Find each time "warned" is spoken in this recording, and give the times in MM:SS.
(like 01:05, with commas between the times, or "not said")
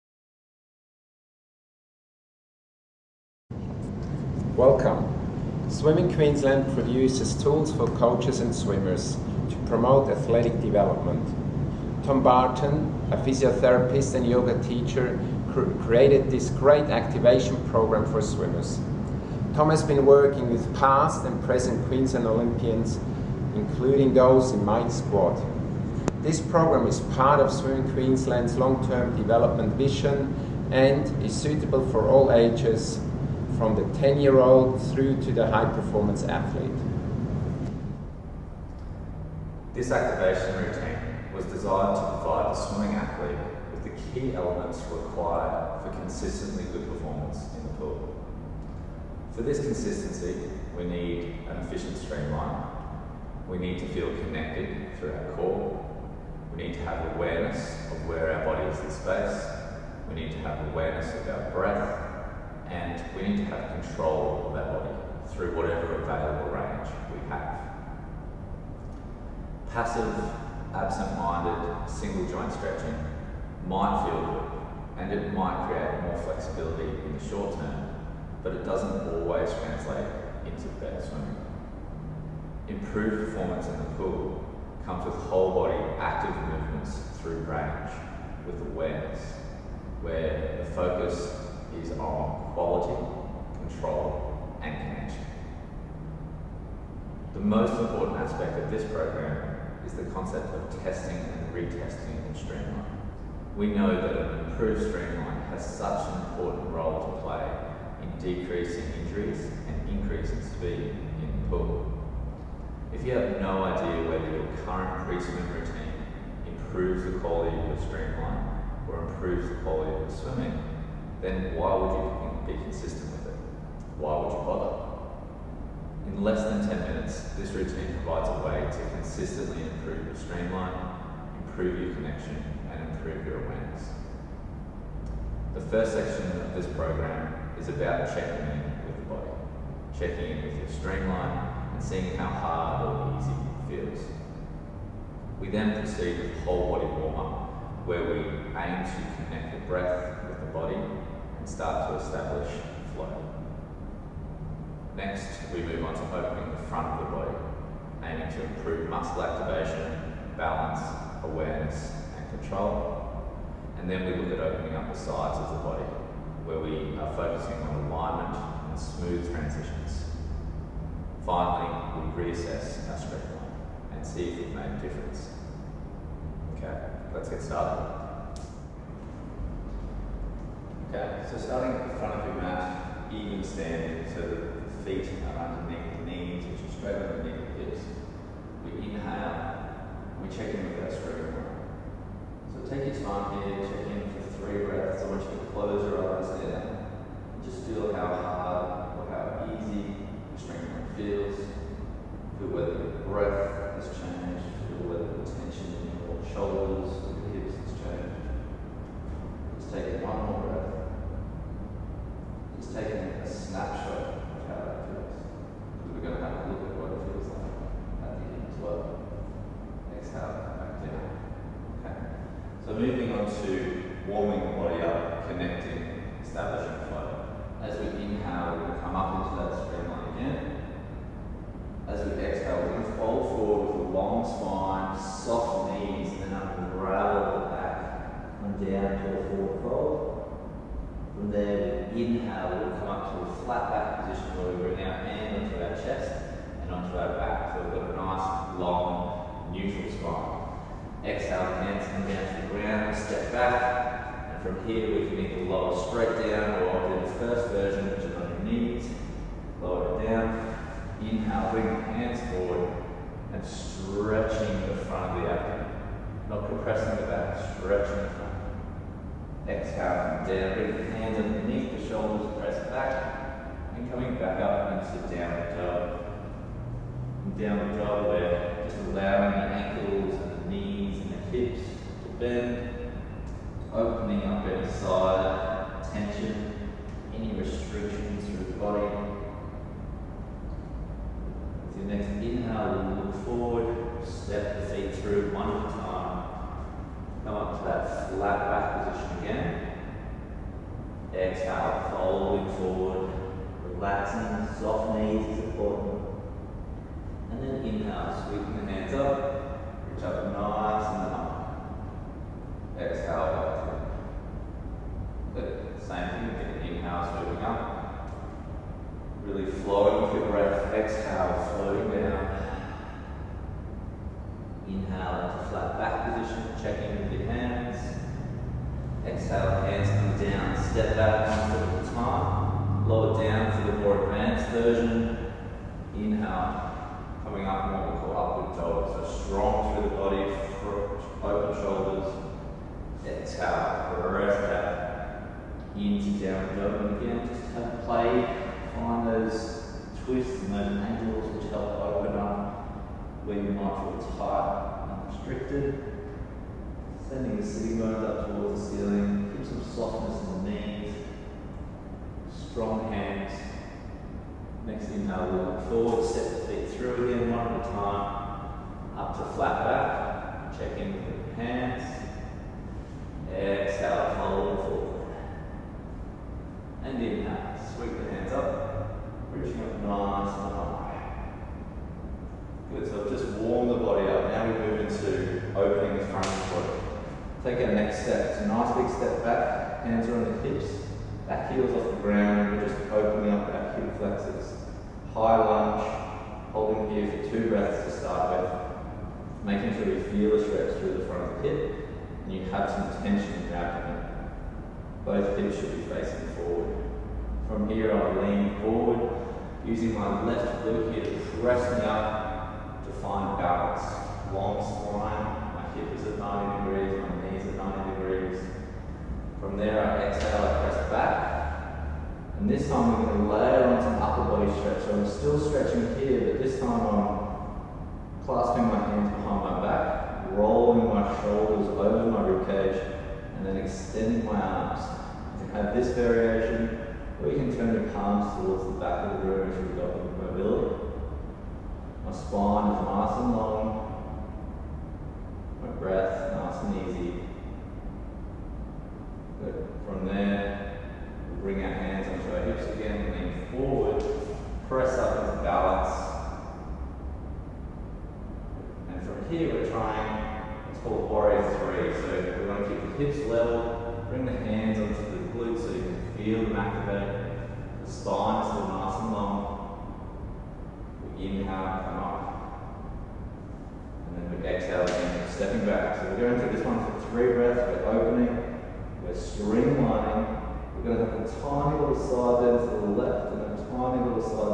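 not said.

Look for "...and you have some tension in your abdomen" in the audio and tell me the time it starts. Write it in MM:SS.
06:42.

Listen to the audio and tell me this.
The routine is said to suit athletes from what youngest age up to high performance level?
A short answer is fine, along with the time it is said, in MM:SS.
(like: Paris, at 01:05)
10, at 00:34.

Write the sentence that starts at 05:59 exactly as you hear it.
Keep some softness in the knee strong hands.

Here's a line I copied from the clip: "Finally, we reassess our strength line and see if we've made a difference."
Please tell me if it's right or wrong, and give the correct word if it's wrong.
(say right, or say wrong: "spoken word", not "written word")
right.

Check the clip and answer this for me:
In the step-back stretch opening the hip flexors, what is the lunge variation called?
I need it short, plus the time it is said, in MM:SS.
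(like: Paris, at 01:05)
High lunge, at 06:35.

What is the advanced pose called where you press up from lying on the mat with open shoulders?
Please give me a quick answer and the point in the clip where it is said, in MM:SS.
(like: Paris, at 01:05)
Upward dog, at 05:38.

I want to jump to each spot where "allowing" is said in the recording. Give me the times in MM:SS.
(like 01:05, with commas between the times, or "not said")
04:38.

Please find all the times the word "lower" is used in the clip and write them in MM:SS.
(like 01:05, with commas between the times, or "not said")
04:15, 04:19, 05:32.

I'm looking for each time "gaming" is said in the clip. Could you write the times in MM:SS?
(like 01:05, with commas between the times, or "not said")
not said.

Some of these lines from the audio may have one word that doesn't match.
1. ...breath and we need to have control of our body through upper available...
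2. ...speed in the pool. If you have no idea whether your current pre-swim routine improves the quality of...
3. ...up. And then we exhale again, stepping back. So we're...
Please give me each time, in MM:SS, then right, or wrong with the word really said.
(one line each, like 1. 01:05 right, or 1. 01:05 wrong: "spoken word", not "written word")
1. 01:01 wrong: "whatever", not "upper"
2. 01:50 right
3. 07:52 right.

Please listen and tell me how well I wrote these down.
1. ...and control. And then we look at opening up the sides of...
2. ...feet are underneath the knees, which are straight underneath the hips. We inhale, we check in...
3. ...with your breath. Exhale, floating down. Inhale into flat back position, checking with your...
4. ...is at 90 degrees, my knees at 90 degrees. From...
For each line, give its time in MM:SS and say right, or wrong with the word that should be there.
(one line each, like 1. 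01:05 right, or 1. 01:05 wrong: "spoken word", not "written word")
1. 02:42 right
2. 03:04 right
3. 05:20 right
4. 06:55 right.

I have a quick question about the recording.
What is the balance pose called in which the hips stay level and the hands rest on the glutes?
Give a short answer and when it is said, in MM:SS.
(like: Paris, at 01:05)
Warrior three, at 07:41.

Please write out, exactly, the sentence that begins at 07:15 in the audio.
You can have this variation, or you can turn your palms towards the back of the room if you've got the mobility.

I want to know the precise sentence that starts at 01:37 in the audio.
The most important aspect of this program is the concept of testing and retesting in Streamline.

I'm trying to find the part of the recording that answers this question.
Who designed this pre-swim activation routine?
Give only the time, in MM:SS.
00:12.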